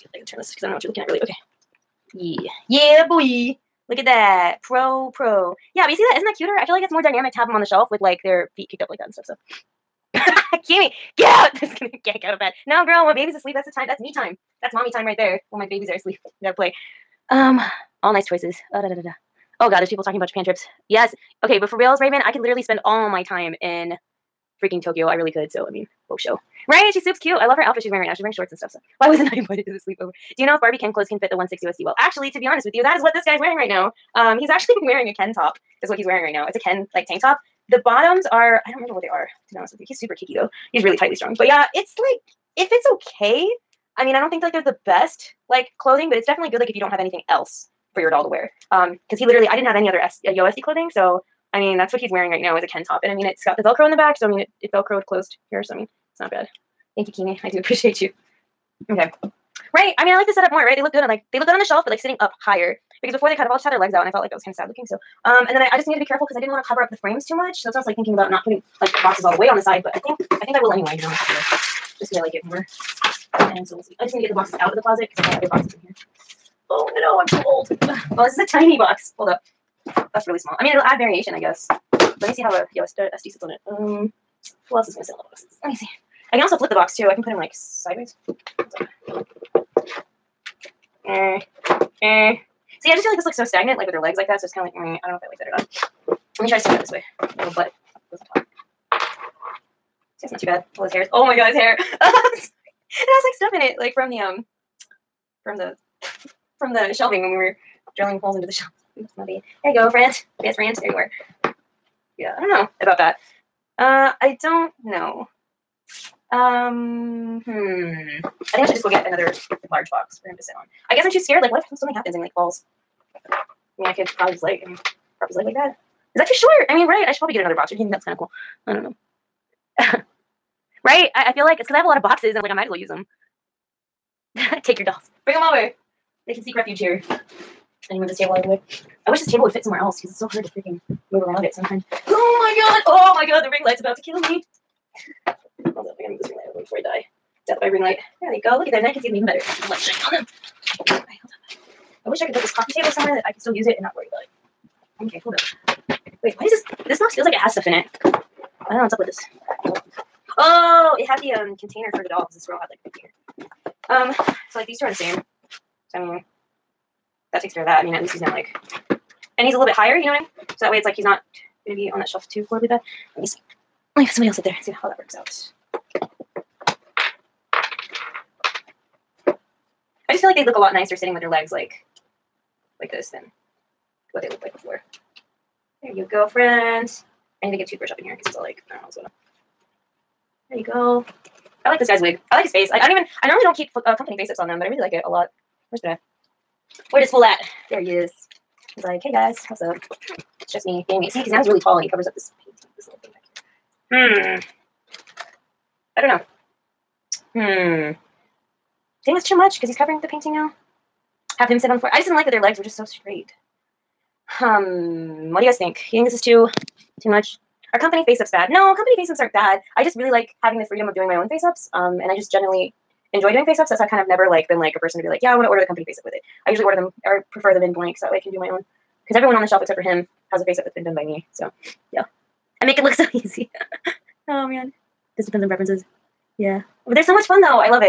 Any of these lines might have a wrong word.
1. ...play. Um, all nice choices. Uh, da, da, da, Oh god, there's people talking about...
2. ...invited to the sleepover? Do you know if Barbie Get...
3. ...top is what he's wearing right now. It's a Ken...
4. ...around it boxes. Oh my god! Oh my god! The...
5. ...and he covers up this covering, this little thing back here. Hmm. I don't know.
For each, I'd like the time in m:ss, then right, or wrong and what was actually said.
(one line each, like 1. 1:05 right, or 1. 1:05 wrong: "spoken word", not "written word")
1. 0:16 right
2. 0:29 wrong: "Ken", not "Get"
3. 0:35 right
4. 2:21 wrong: "sometimes", not "boxes"
5. 3:21 wrong: "painting", not "covering".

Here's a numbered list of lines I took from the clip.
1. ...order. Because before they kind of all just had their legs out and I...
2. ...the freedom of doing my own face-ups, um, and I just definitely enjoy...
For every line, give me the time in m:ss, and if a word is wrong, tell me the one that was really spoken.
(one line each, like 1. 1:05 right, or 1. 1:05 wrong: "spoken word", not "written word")
1. 1:02 wrong: "higher", not "order"
2. 3:40 wrong: "generally", not "definitely".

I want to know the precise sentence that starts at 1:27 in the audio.
I can put him, like, sideways.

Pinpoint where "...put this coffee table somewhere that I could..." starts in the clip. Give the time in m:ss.
2:32.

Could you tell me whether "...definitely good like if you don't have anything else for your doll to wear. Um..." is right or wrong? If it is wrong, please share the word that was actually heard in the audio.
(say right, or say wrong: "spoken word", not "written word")
right.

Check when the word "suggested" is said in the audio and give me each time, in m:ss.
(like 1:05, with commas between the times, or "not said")
not said.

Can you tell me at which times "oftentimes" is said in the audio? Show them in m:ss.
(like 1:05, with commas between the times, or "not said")
not said.